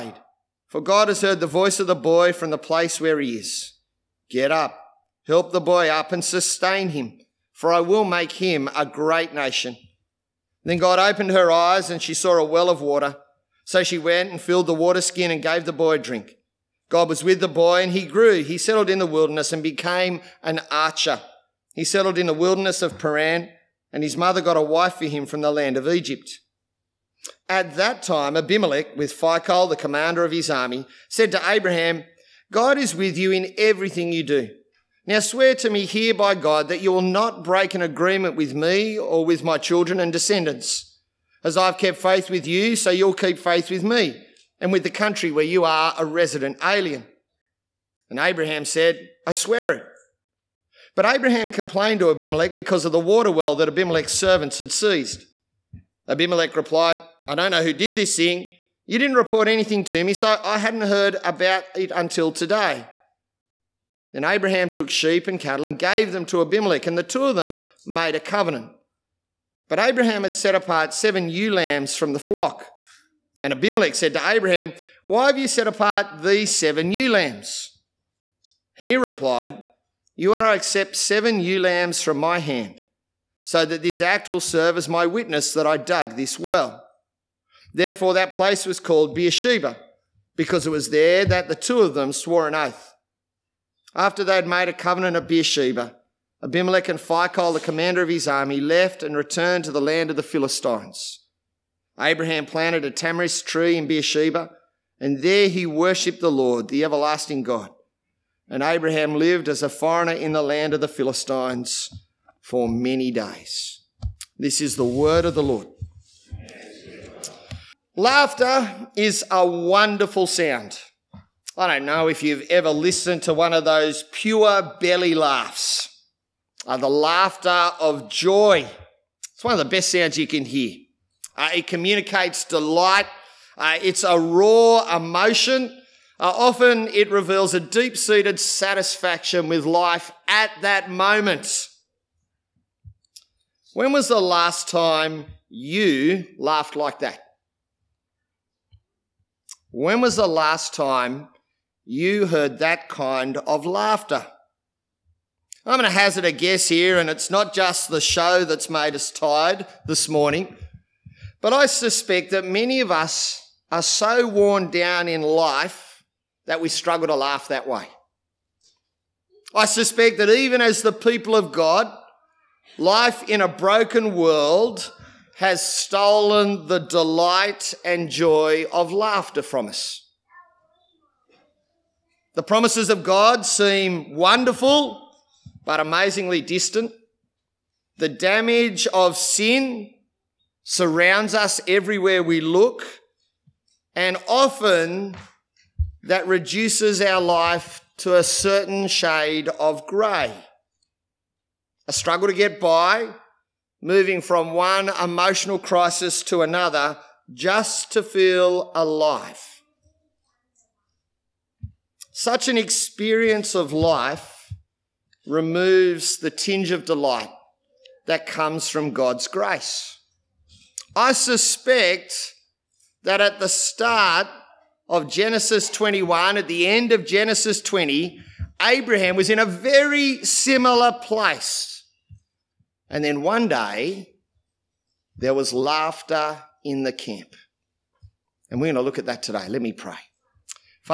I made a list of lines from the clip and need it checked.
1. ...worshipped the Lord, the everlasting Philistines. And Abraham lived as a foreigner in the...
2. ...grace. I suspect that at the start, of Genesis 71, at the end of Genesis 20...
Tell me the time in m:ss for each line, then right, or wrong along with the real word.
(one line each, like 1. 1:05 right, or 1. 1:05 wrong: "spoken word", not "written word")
1. 1:45 wrong: "God", not "Philistines"
2. 3:39 wrong: "21", not "71".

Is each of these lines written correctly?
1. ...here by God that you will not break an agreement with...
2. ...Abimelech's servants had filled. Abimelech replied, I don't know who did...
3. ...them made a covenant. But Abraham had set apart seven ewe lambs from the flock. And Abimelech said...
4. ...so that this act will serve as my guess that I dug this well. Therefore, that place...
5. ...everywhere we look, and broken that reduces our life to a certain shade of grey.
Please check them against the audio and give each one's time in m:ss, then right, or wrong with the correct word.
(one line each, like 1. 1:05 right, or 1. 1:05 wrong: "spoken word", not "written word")
1. 0:35 right
2. 0:53 wrong: "seized", not "filled"
3. 1:07 right
4. 1:23 wrong: "witness", not "guess"
5. 3:11 wrong: "often", not "broken".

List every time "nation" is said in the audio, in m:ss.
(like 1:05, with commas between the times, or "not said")
0:09.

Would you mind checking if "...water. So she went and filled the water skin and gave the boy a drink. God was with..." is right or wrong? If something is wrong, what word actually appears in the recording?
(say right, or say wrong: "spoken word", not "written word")
right.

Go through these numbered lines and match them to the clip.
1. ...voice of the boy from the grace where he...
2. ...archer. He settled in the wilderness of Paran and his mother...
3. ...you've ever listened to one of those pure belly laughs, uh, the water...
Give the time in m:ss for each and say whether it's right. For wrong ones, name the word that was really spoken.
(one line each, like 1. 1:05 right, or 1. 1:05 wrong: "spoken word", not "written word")
1. 0:01 wrong: "place", not "grace"
2. 0:20 right
3. 2:02 wrong: "laughter", not "water".